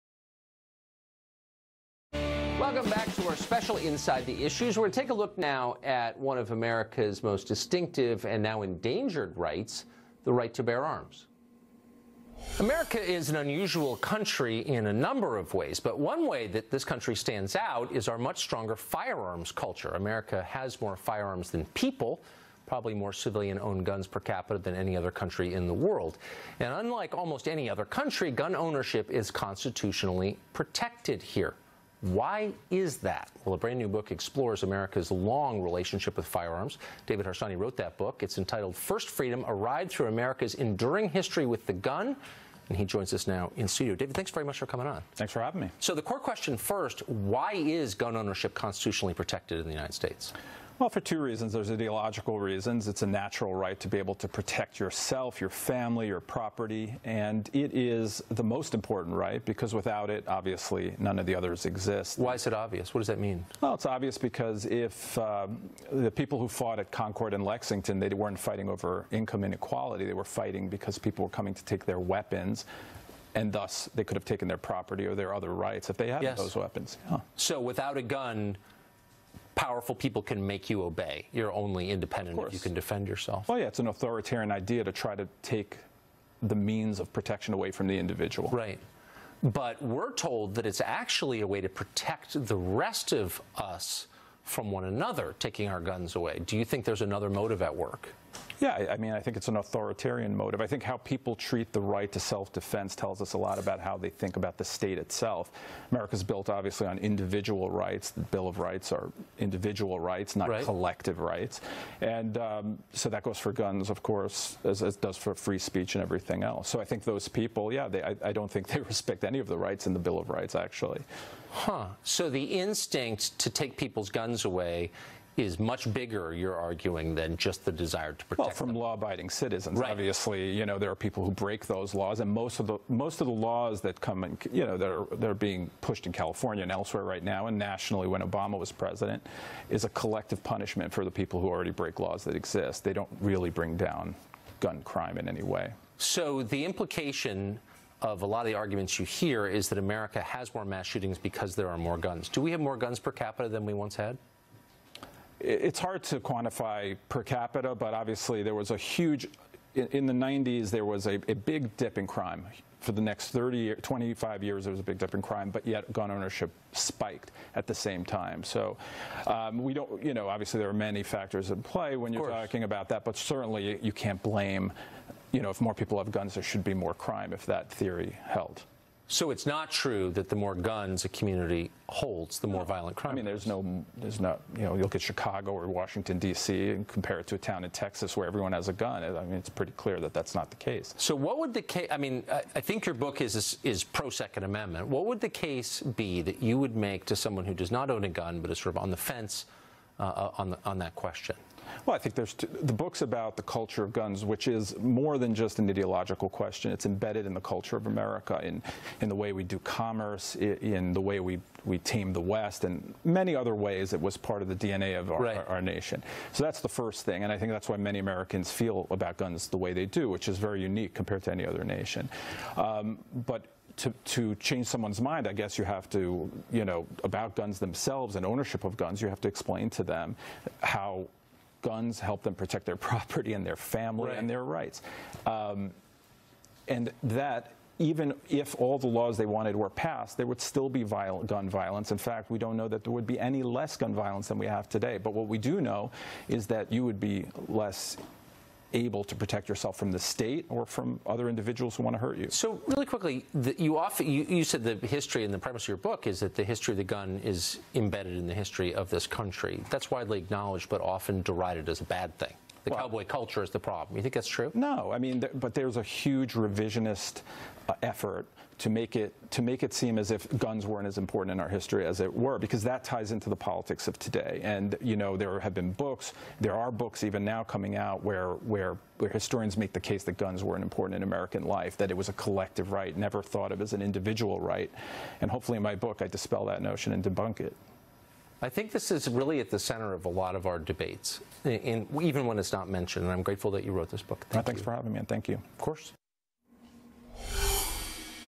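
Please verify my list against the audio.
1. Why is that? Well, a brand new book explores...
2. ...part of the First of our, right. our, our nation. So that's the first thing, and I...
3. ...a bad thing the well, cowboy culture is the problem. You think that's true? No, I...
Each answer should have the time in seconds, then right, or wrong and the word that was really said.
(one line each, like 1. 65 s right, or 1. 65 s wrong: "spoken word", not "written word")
1. 32 s right
2. 214 s wrong: "DNA", not "First"
3. 261 s right.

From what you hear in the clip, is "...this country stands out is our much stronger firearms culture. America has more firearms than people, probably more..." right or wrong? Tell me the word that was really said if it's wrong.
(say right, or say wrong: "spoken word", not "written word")
right.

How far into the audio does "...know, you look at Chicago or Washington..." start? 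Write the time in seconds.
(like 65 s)
184 s.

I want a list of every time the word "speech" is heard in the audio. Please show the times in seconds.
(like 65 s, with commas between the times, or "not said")
115 s.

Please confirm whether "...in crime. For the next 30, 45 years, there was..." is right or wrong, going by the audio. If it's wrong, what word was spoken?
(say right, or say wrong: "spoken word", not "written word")
wrong: "25", not "45".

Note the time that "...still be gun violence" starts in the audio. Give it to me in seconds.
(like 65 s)
240 s.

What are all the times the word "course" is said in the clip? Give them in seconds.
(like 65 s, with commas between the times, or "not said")
114 s, 295 s.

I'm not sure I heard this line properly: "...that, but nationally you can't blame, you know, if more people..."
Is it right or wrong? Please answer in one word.
wrong.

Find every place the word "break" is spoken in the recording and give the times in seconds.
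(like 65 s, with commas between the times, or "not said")
131 s, 141 s.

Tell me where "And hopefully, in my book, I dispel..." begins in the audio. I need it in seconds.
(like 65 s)
285 s.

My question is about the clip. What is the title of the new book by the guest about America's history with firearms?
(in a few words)
First Freedom.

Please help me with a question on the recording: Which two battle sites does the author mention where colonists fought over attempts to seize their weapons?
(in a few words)
Concord and Lexington.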